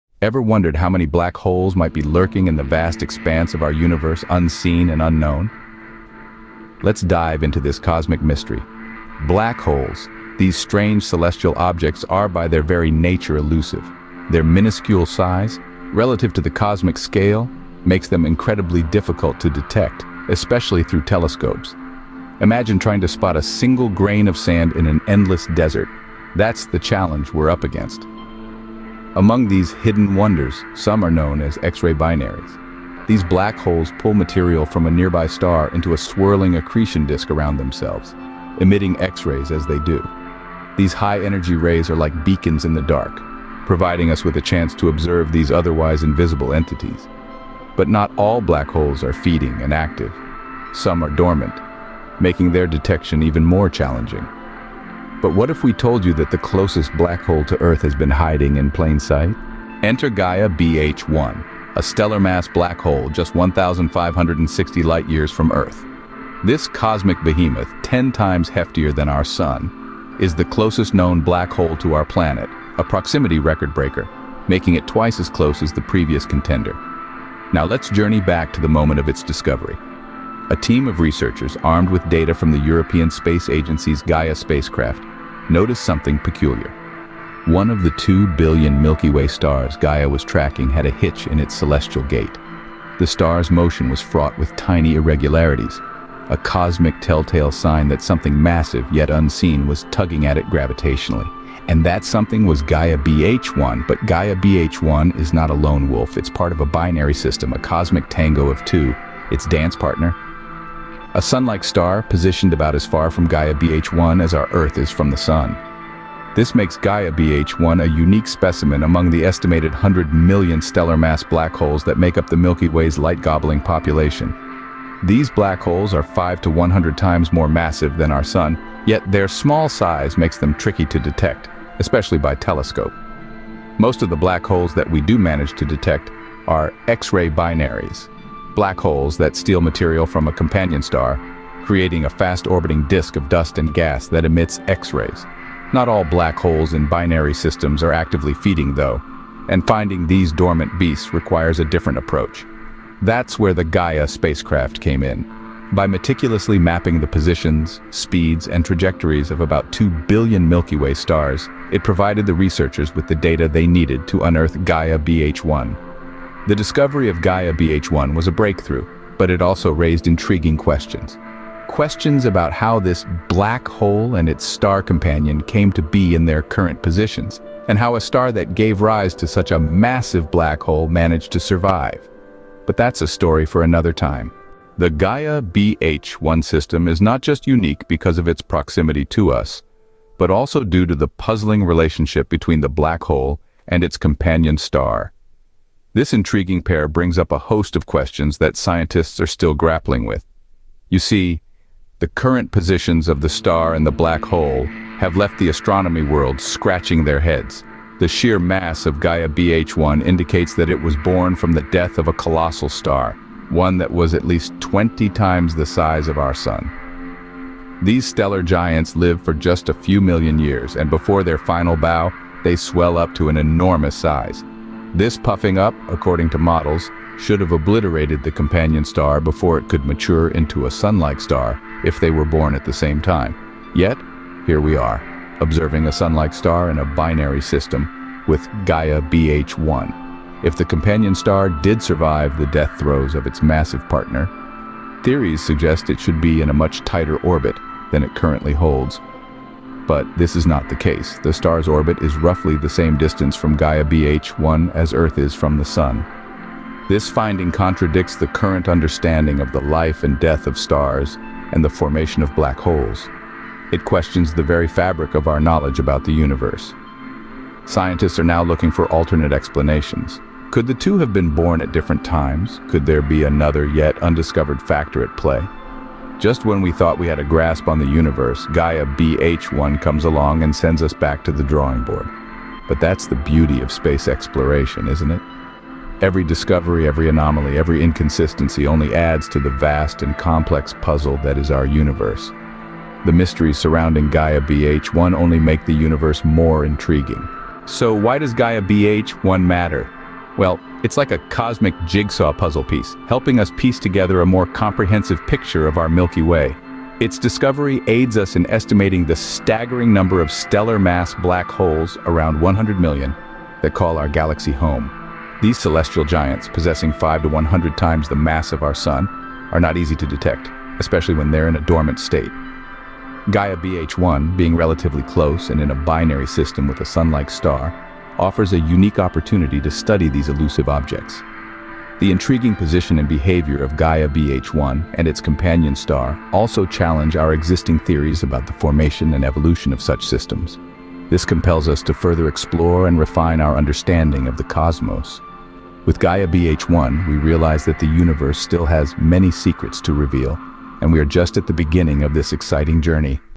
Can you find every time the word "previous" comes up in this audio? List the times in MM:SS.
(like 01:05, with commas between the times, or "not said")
01:15.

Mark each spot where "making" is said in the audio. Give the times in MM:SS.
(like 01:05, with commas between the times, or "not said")
00:52, 01:14.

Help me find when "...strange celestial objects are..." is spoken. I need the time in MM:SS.
00:10.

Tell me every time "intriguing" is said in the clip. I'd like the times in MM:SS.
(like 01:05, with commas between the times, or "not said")
02:50, 03:16, 04:56, 05:32.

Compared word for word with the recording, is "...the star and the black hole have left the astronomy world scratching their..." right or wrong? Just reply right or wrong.
right.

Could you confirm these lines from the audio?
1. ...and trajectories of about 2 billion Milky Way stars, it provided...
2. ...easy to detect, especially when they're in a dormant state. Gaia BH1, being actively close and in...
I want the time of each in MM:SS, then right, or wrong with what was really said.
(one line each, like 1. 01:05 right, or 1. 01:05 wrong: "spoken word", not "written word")
1. 02:38 right
2. 05:19 wrong: "relatively", not "actively".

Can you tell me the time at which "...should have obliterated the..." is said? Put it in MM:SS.
03:47.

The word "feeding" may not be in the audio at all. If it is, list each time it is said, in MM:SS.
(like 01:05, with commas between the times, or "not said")
00:49, 02:28.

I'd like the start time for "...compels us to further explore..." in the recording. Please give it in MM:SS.
05:41.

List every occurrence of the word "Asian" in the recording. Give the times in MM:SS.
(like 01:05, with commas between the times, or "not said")
not said.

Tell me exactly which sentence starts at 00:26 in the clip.
That's the challenge we're up against.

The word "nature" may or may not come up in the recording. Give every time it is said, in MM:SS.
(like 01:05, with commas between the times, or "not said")
00:12.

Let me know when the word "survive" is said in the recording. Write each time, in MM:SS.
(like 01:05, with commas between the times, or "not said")
03:01, 04:01.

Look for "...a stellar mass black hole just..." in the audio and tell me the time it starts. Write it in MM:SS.
01:01.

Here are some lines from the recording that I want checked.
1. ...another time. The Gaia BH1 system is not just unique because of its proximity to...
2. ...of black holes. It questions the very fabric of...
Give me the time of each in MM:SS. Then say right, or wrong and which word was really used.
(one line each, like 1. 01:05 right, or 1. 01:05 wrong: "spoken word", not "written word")
1. 03:03 right
2. 04:22 right.